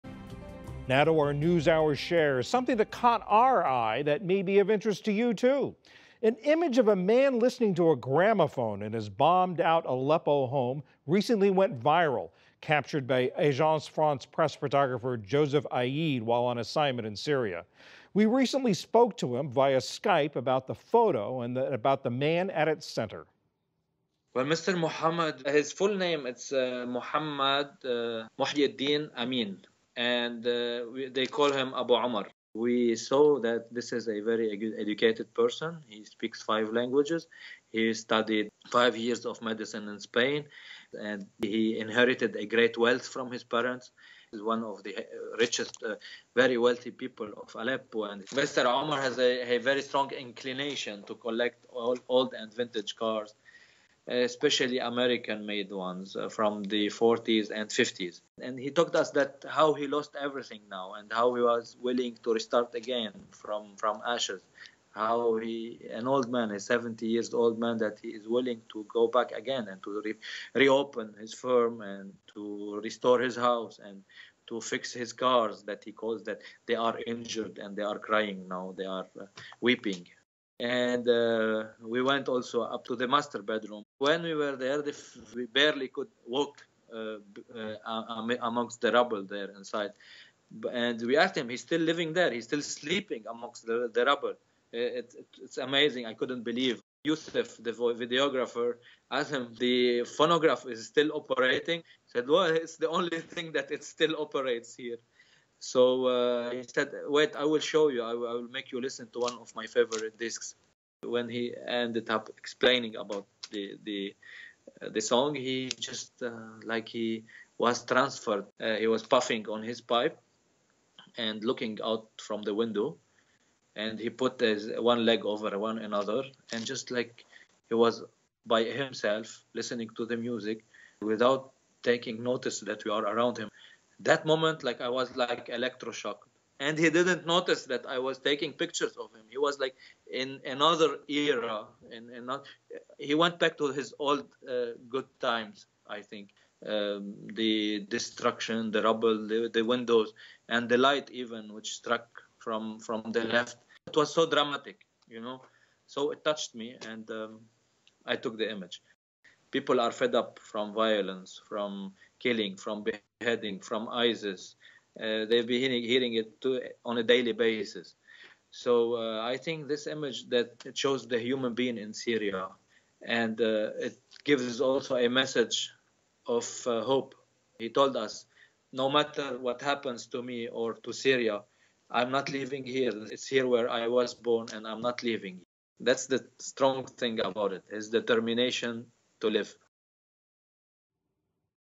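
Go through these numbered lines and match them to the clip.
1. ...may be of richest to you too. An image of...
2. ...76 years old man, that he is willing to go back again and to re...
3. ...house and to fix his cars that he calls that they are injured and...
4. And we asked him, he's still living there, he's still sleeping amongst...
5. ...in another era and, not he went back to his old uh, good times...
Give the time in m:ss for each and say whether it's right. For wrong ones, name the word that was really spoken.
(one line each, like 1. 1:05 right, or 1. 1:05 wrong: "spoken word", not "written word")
1. 0:04 wrong: "interest", not "richest"
2. 1:06 wrong: "70", not "76"
3. 1:13 right
4. 1:30 right
5. 2:20 right.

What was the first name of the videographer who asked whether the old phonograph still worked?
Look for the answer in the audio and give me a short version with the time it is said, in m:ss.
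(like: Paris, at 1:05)
Yusuf, at 1:37.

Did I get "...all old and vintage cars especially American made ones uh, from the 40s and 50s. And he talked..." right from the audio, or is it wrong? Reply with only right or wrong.
right.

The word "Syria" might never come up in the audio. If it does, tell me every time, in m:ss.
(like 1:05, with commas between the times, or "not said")
0:17, 2:51, 3:00.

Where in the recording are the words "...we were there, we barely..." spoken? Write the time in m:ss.
1:24.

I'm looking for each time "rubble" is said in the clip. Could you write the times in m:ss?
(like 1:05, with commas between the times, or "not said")
1:28, 1:34, 2:28.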